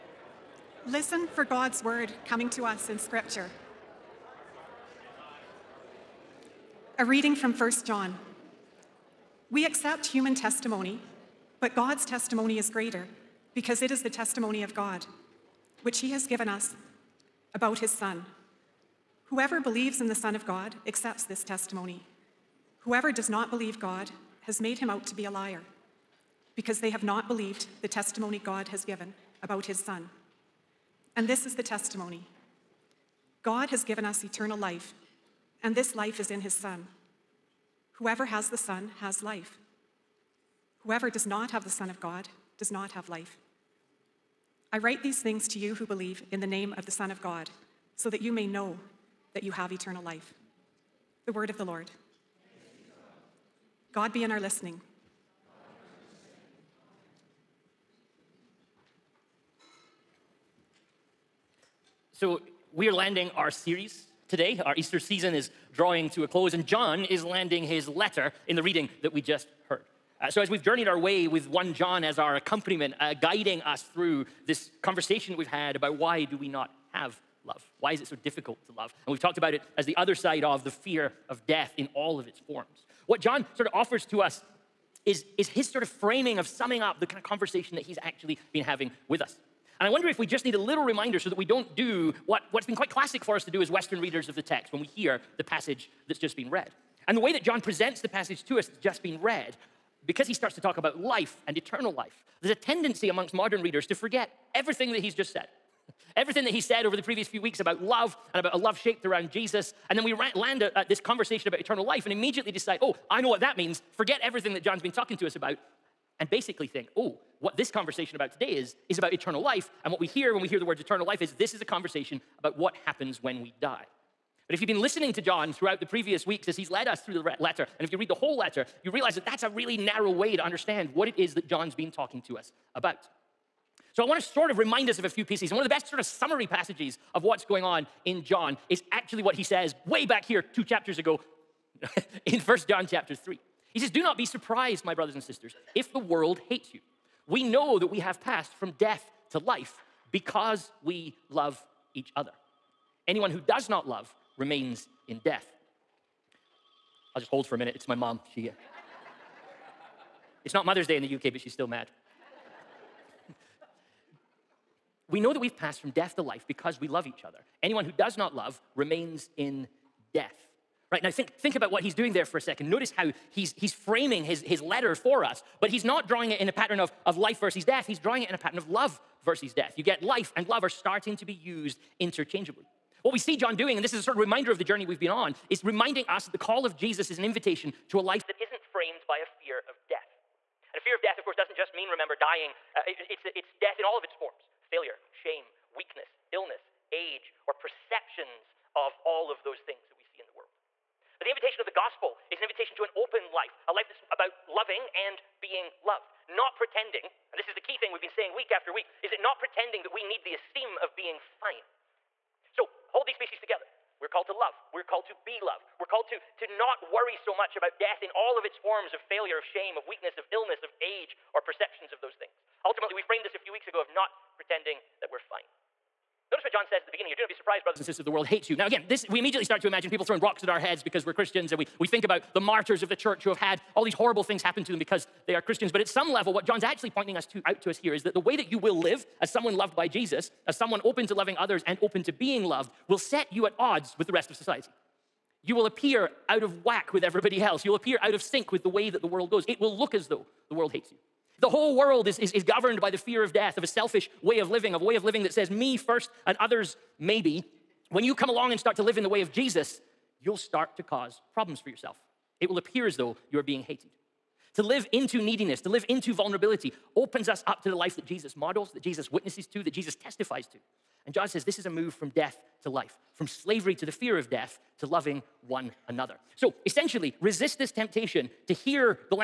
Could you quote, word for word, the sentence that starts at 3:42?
Ultimately, we framed this a few weeks ago of not pretending that we're fine.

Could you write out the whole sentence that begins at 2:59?
You get life and love are starting to be used interchangeably.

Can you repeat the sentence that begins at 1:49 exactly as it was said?
And then we land at this conversation about eternal life and immediately decide, oh, I know what that means.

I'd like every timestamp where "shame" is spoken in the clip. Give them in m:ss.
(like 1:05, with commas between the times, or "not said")
3:15, 3:39.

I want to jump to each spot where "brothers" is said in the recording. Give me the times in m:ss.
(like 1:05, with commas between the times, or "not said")
2:24, 3:47.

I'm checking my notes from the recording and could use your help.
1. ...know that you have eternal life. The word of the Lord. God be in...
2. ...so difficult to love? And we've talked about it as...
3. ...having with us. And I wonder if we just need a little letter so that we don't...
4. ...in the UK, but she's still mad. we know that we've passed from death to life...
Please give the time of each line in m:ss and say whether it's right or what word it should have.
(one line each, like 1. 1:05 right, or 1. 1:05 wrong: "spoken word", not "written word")
1. 0:48 right
2. 1:18 right
3. 1:28 wrong: "reminder", not "letter"
4. 2:40 right.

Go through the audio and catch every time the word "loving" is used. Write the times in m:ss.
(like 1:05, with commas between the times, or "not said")
3:24, 4:01, 4:34.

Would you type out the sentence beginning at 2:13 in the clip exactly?
So I want to sort of remind us of a few pieces.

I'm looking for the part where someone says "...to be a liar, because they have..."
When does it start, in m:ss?
0:25.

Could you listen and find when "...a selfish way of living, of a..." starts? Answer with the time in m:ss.
4:13.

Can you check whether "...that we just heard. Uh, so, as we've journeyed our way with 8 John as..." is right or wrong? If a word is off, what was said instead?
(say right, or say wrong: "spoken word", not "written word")
wrong: "1", not "8".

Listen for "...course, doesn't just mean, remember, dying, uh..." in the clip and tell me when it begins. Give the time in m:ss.
3:11.